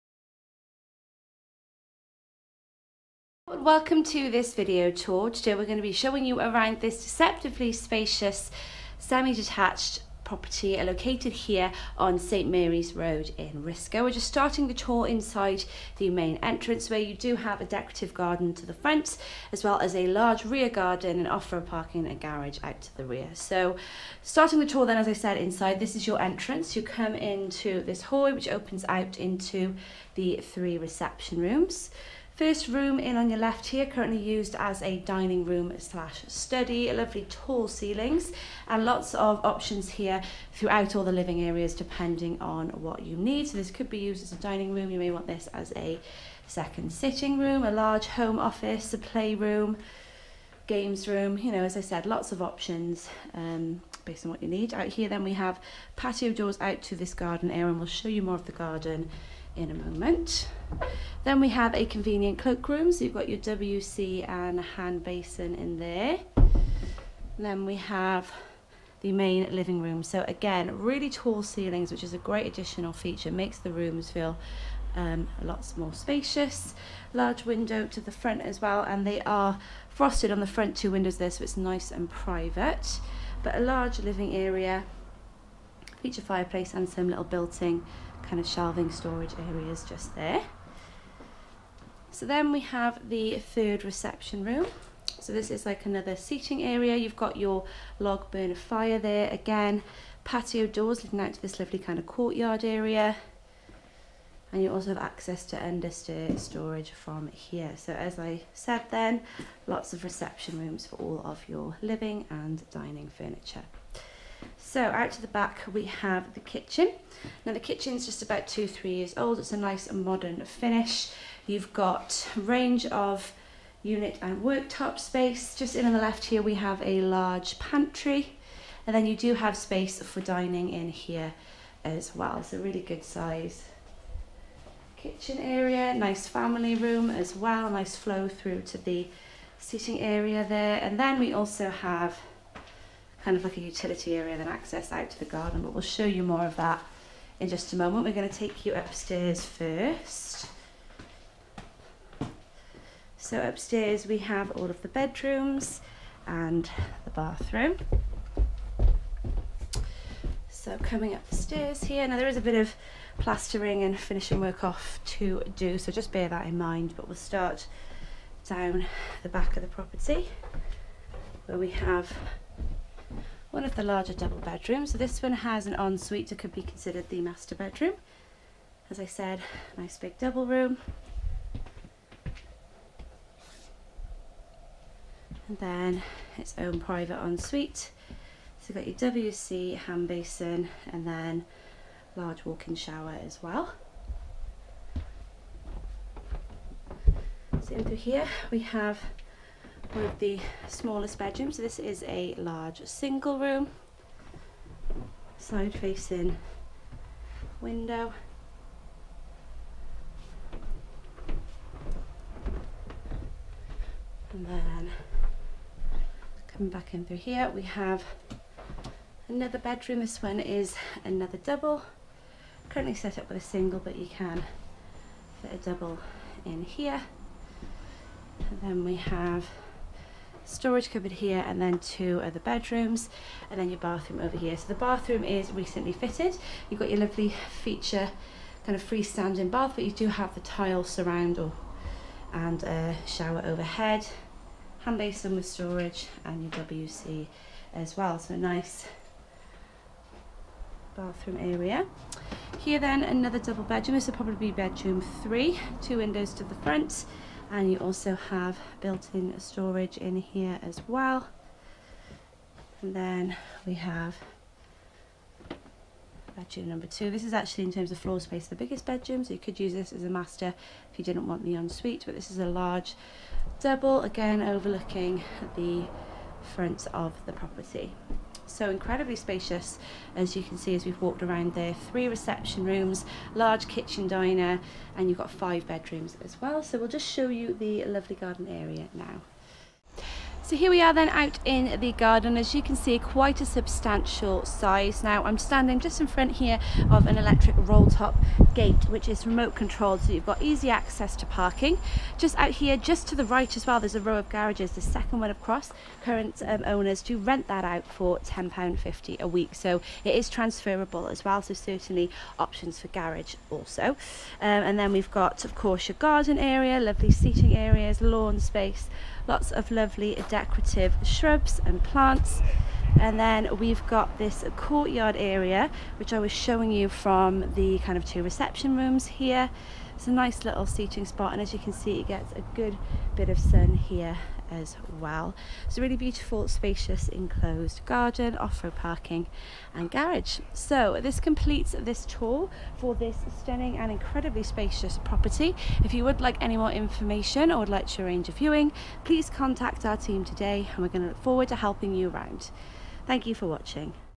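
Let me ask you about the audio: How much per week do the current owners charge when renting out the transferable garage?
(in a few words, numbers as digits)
£10.50.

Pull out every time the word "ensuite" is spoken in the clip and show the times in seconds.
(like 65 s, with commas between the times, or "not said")
175 s, 187 s, 271 s.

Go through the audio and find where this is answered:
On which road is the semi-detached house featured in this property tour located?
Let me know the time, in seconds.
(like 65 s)
12 s.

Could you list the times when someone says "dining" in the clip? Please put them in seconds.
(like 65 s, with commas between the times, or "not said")
34 s, 44 s, 112 s, 130 s.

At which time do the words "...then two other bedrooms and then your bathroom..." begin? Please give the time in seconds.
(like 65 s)
231 s.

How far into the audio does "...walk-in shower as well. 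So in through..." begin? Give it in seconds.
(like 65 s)
192 s.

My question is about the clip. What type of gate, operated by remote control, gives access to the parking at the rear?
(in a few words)
Electric roll top gate.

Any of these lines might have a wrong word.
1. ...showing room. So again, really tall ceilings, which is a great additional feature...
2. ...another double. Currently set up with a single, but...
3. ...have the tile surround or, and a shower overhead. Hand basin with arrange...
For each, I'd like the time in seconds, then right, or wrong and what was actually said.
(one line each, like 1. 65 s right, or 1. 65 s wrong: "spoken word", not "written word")
1. 69 s wrong: "living", not "showing"
2. 221 s right
3. 240 s wrong: "storage", not "arrange".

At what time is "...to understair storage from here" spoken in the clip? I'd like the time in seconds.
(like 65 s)
105 s.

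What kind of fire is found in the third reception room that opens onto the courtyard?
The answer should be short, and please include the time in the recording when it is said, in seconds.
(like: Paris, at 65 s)
Log burner, at 97 s.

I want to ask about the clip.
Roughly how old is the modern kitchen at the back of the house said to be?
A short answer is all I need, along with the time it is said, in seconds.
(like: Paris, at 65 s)
2 to 3 years, at 118 s.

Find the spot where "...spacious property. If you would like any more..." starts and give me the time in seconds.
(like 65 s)
344 s.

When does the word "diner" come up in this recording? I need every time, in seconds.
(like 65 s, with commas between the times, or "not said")
284 s.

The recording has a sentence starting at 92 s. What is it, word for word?
So then we have the third reception room.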